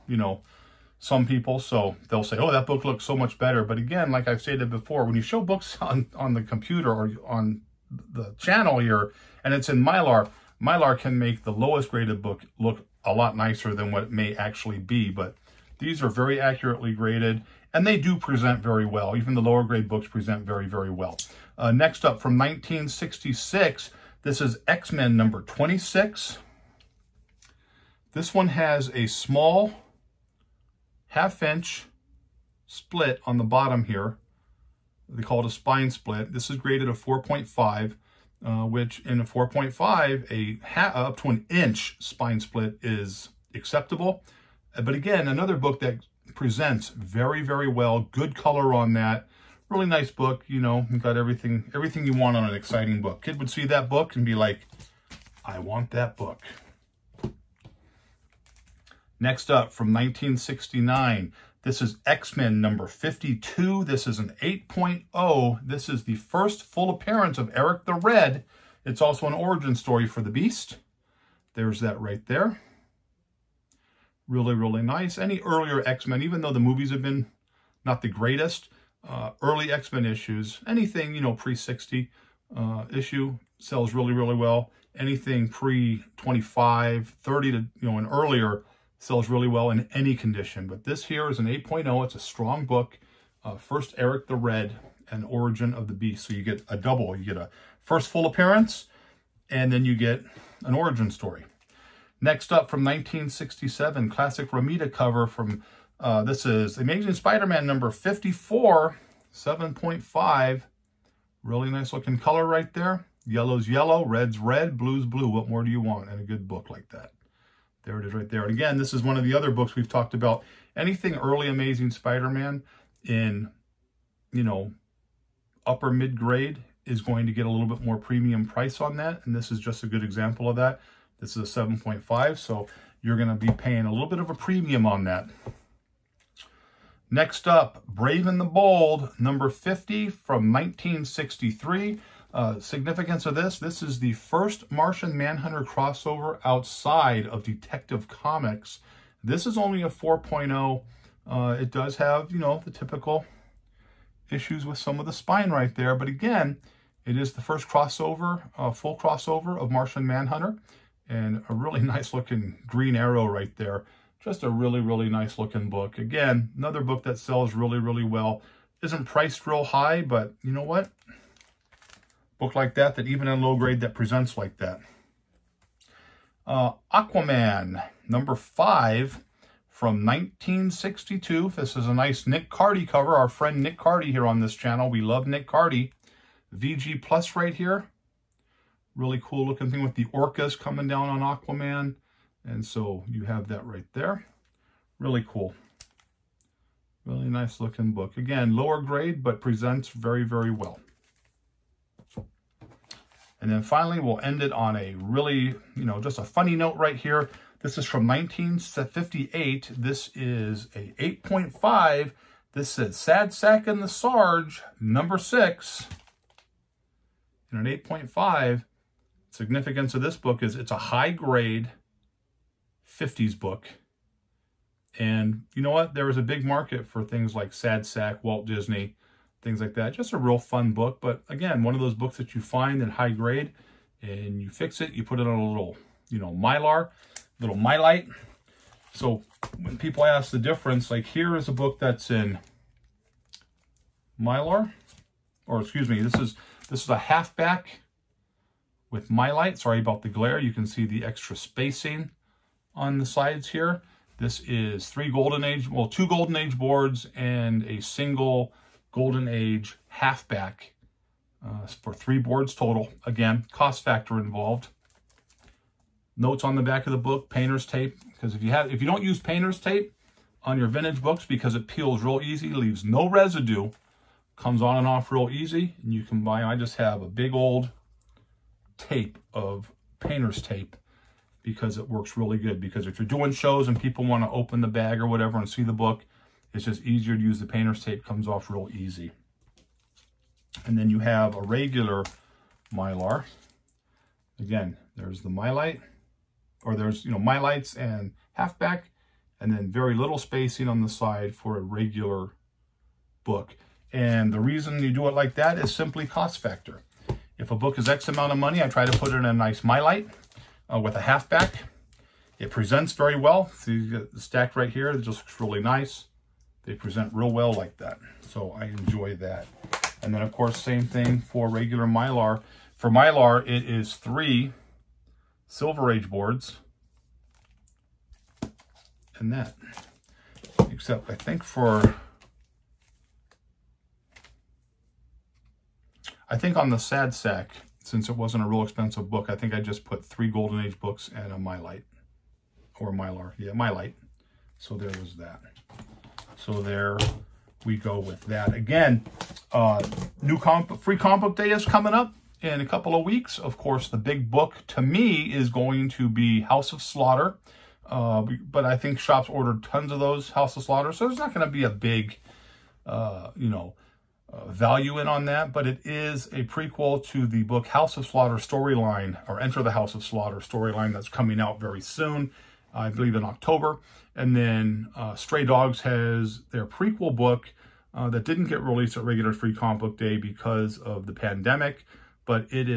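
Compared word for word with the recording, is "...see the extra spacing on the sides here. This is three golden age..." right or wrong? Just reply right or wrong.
right.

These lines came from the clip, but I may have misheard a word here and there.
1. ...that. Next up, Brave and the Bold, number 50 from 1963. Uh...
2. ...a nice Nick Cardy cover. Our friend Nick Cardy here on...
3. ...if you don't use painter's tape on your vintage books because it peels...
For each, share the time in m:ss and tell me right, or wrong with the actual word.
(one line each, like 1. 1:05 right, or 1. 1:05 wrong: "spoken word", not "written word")
1. 2:15 right
2. 3:01 right
3. 4:28 right.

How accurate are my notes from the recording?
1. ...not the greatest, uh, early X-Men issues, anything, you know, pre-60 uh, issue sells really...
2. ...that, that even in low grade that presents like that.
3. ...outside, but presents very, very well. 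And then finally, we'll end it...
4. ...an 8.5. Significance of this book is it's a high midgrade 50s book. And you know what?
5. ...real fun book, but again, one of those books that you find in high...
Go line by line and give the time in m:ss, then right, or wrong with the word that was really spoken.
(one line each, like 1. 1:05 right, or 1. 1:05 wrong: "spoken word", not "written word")
1. 1:17 right
2. 2:52 right
3. 3:18 wrong: "grade", not "outside"
4. 3:37 wrong: "grade", not "midgrade"
5. 3:50 right.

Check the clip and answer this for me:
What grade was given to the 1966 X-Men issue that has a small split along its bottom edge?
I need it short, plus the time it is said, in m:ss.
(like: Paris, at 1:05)
4.5, at 0:36.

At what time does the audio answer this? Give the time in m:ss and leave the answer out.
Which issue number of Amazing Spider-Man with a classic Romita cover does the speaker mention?
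1:46.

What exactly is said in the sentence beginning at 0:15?
But these are very accurately graded, and they do present very well.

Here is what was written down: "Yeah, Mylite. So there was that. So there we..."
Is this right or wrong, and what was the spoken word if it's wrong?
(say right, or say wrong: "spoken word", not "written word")
right.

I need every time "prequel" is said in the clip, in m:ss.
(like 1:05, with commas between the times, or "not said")
6:06, 6:16.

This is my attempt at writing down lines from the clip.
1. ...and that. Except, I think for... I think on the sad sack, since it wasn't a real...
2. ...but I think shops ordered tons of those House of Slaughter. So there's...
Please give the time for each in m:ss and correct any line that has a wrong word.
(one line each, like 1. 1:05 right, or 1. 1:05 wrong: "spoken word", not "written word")
1. 5:29 right
2. 5:58 right.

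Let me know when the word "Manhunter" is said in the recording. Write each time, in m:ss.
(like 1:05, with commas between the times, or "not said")
2:25, 2:40.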